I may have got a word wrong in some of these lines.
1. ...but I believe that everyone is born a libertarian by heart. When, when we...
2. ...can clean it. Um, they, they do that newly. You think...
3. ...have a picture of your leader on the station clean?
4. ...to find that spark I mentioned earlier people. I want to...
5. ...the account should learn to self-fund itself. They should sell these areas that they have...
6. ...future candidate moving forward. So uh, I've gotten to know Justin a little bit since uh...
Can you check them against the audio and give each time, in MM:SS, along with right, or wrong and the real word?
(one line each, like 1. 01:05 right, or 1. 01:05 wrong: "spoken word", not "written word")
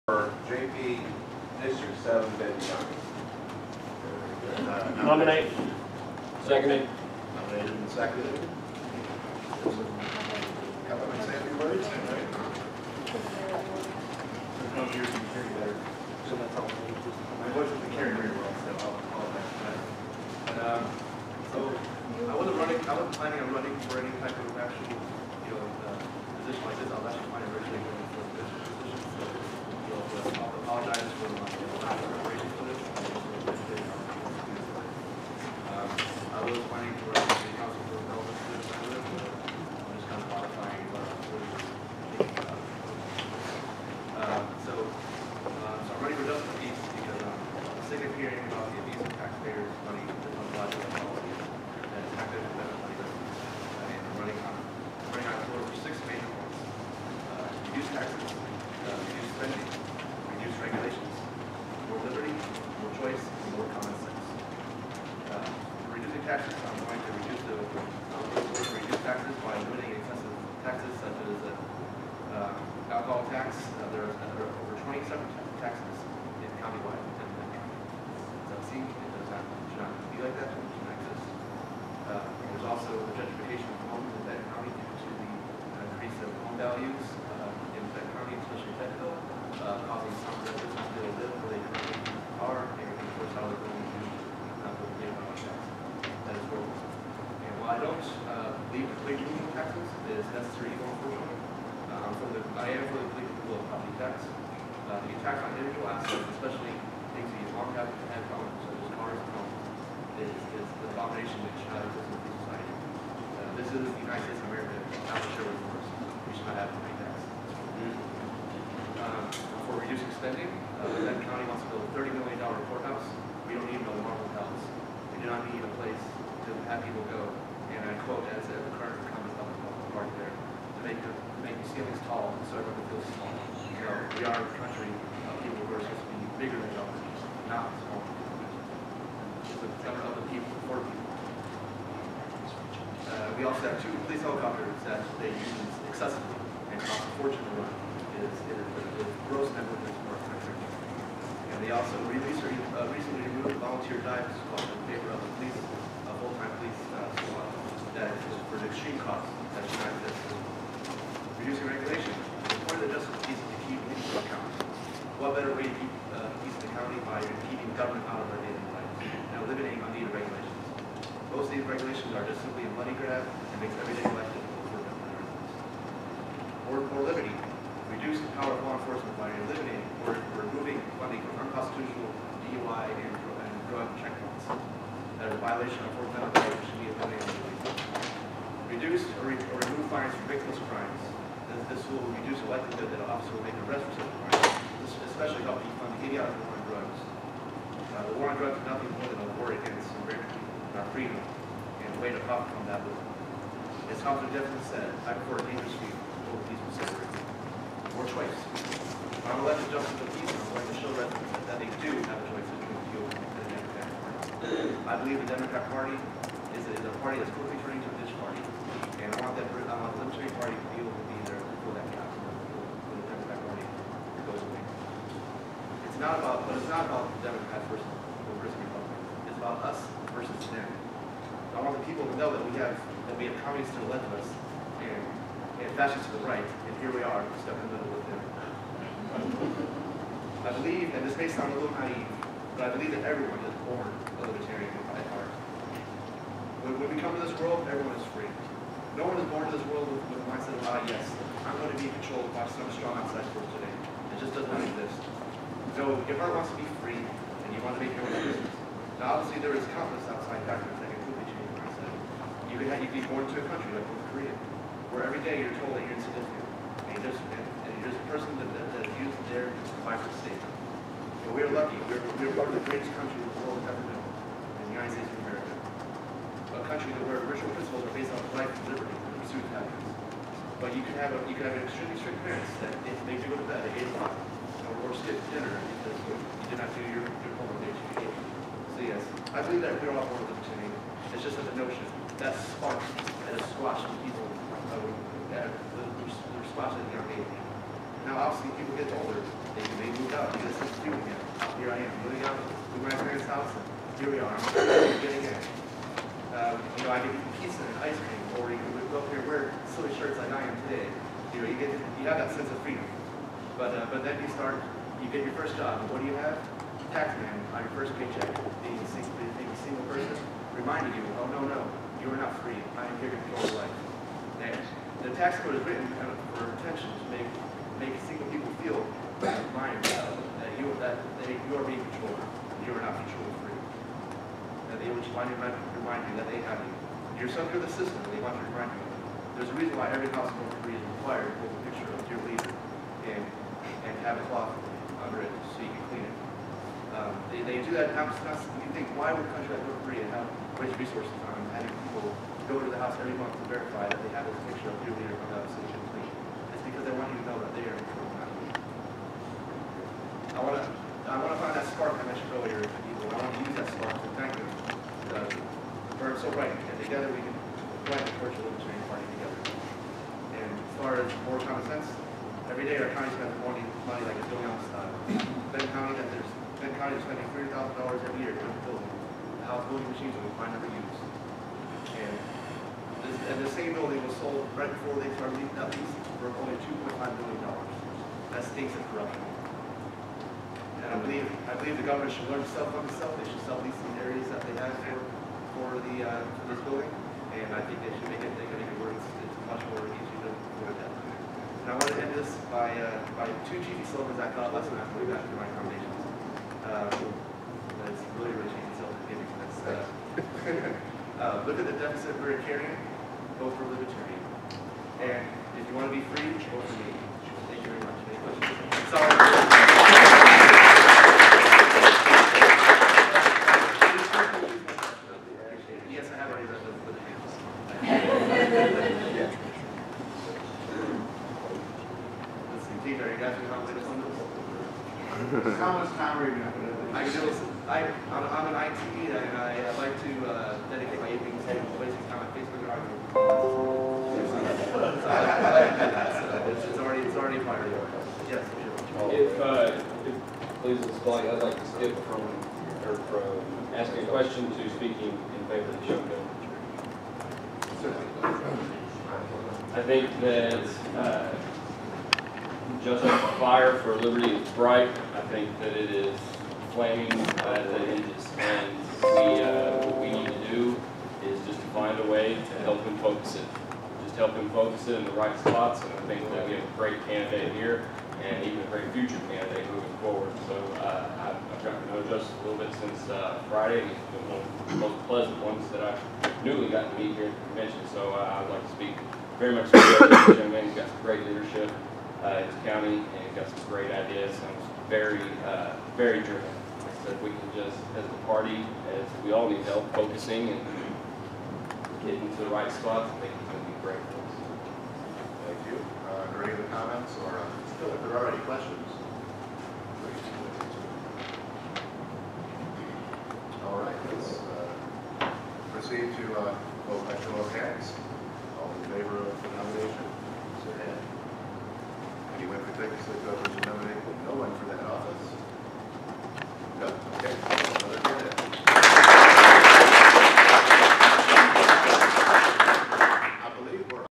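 1. 04:02 right
2. 05:45 wrong: "constantly", not "newly"
3. 05:54 right
4. 06:01 right
5. 06:31 wrong: "government", not "account"
6. 07:58 right.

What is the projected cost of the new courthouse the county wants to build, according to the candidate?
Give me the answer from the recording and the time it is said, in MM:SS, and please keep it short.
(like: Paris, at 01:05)
$30 million, at 02:02.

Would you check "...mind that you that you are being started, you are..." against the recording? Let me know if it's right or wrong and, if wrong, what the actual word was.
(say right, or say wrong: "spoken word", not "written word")
wrong: "controlled", not "started".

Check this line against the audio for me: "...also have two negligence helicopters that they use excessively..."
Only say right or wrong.
wrong.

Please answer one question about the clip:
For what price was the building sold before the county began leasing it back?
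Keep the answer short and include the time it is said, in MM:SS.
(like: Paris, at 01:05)
$2.5 million, at 06:26.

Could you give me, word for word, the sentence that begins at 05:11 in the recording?
You know, you get you have that sense of freedom.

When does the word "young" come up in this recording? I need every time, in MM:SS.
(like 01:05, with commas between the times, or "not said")
00:04, 04:56, 08:10.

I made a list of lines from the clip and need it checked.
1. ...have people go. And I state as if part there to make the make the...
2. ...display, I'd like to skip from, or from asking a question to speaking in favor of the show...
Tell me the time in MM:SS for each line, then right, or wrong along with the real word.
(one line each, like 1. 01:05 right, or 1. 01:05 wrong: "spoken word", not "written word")
1. 02:06 wrong: "quote", not "state"
2. 07:30 right.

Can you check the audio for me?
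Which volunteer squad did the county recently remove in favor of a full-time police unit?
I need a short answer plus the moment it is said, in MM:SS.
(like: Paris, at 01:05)
dive squad, at 02:34.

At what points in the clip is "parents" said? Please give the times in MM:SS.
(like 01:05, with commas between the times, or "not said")
04:42, 05:02.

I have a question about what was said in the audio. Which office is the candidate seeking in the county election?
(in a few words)
justice of peace.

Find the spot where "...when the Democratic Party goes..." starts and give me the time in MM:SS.
03:42.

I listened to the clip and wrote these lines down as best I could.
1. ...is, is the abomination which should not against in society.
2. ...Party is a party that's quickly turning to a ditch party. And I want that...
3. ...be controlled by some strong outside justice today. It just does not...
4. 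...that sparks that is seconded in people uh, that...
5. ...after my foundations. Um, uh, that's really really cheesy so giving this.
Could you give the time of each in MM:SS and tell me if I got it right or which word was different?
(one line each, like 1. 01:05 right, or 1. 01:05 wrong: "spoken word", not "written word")
1. 01:50 wrong: "exist", not "against"
2. 03:35 right
3. 04:11 wrong: "force", not "justice"
4. 04:52 wrong: "squashed", not "seconded"
5. 06:45 right.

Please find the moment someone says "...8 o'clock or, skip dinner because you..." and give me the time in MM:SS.
04:43.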